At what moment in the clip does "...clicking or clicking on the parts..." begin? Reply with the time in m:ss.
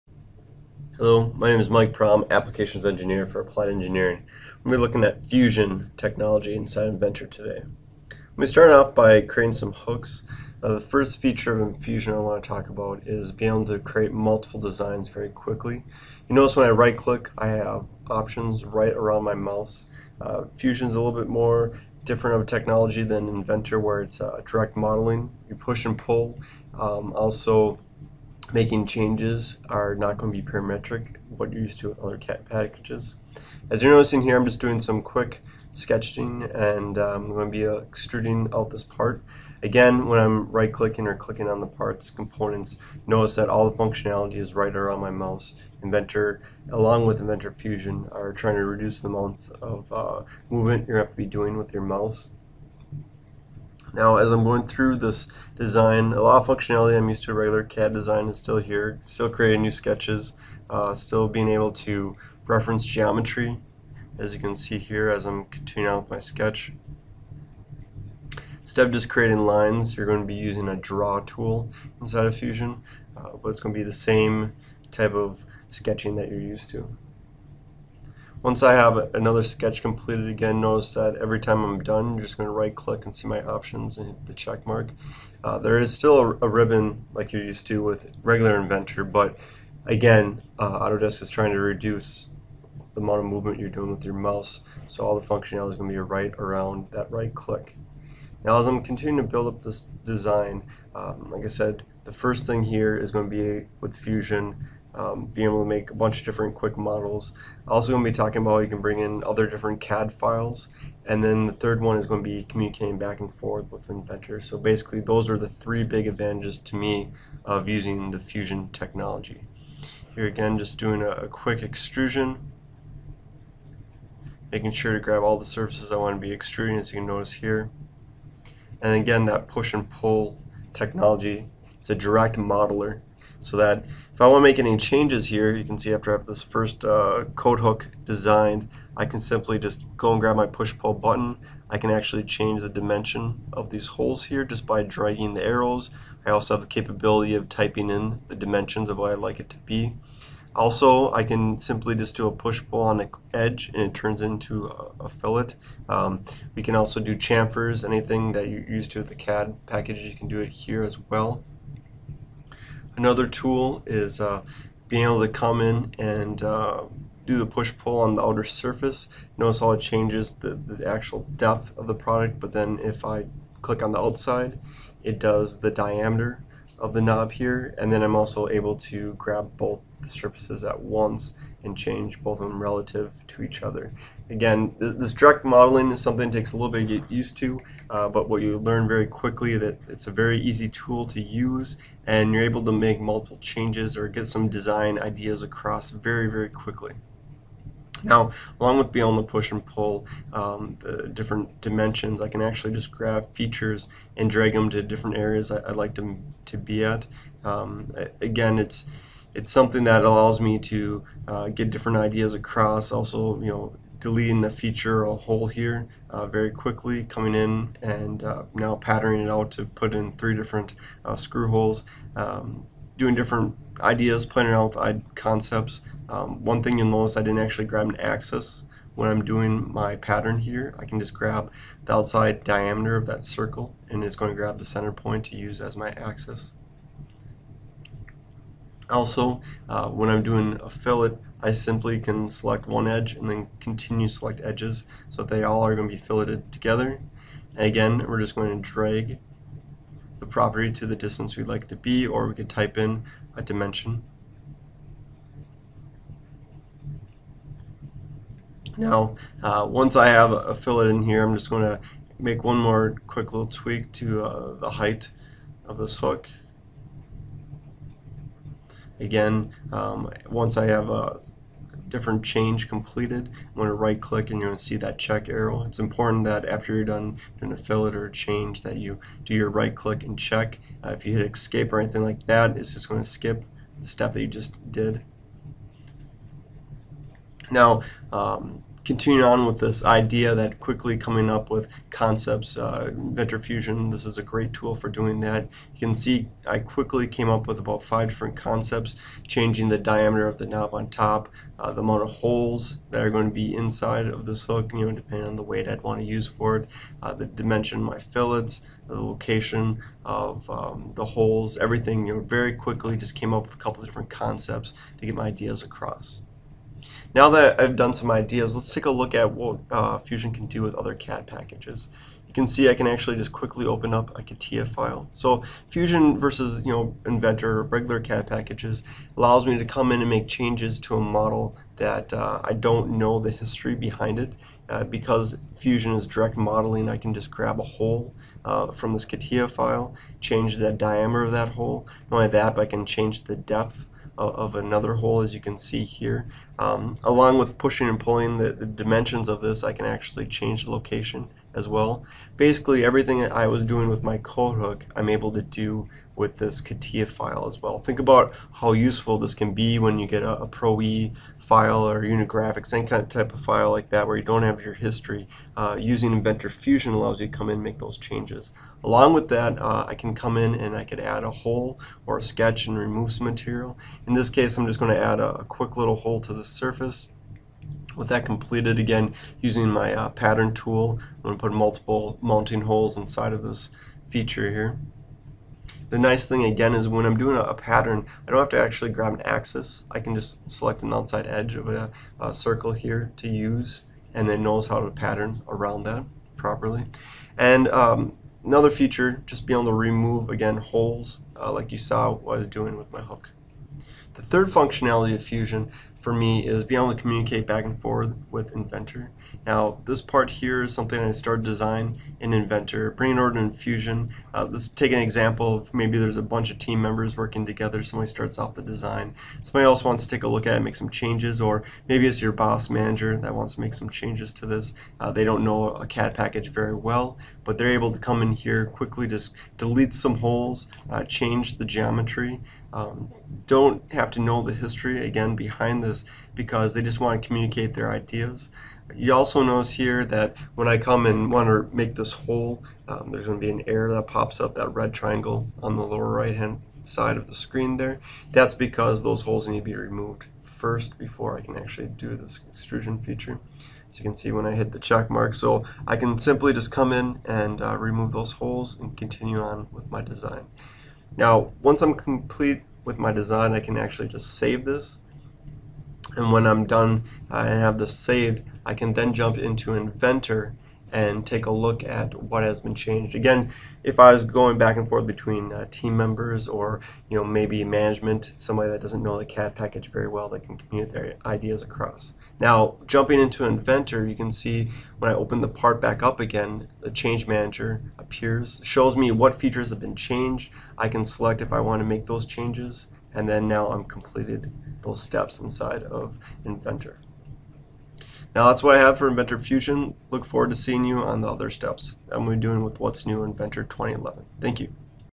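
0:40.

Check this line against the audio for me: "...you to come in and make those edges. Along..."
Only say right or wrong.
wrong.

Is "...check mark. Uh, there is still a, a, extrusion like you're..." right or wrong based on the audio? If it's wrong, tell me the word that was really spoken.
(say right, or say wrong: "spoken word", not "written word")
wrong: "ribbon", not "extrusion".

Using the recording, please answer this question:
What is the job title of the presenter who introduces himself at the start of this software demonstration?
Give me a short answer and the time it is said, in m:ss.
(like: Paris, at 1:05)
Applications Engineer, at 0:02.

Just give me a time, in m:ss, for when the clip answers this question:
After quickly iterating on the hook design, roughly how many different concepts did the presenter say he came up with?
4:57.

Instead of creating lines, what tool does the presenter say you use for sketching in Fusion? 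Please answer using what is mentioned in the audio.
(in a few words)
Draw tool.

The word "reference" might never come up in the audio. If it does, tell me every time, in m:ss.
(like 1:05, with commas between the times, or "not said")
1:02.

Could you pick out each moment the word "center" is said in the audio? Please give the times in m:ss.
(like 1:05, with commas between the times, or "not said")
3:54.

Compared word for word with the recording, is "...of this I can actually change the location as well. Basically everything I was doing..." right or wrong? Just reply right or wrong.
right.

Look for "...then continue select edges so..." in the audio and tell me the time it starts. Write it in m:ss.
4:03.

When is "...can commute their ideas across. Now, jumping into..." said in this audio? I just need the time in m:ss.
8:00.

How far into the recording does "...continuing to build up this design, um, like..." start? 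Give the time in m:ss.
1:38.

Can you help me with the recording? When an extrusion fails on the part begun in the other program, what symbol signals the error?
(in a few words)
Red triangle.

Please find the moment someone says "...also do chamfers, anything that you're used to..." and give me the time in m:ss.
2:36.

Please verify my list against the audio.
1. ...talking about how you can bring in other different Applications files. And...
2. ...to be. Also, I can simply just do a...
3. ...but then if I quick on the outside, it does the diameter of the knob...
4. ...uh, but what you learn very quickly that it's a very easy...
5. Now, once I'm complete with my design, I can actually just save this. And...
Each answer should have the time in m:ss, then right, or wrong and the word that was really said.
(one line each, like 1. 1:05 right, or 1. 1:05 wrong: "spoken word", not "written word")
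1. 1:48 wrong: "CAD", not "Applications"
2. 2:29 right
3. 2:52 wrong: "click", not "quick"
4. 3:07 right
5. 7:41 right.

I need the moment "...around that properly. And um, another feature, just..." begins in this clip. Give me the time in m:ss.
6:35.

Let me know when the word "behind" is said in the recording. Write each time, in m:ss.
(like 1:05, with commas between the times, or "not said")
5:33, 7:15.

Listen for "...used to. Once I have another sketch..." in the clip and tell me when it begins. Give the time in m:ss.
1:16.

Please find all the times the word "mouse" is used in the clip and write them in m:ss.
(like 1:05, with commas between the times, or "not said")
0:19, 0:45, 0:51, 1:34.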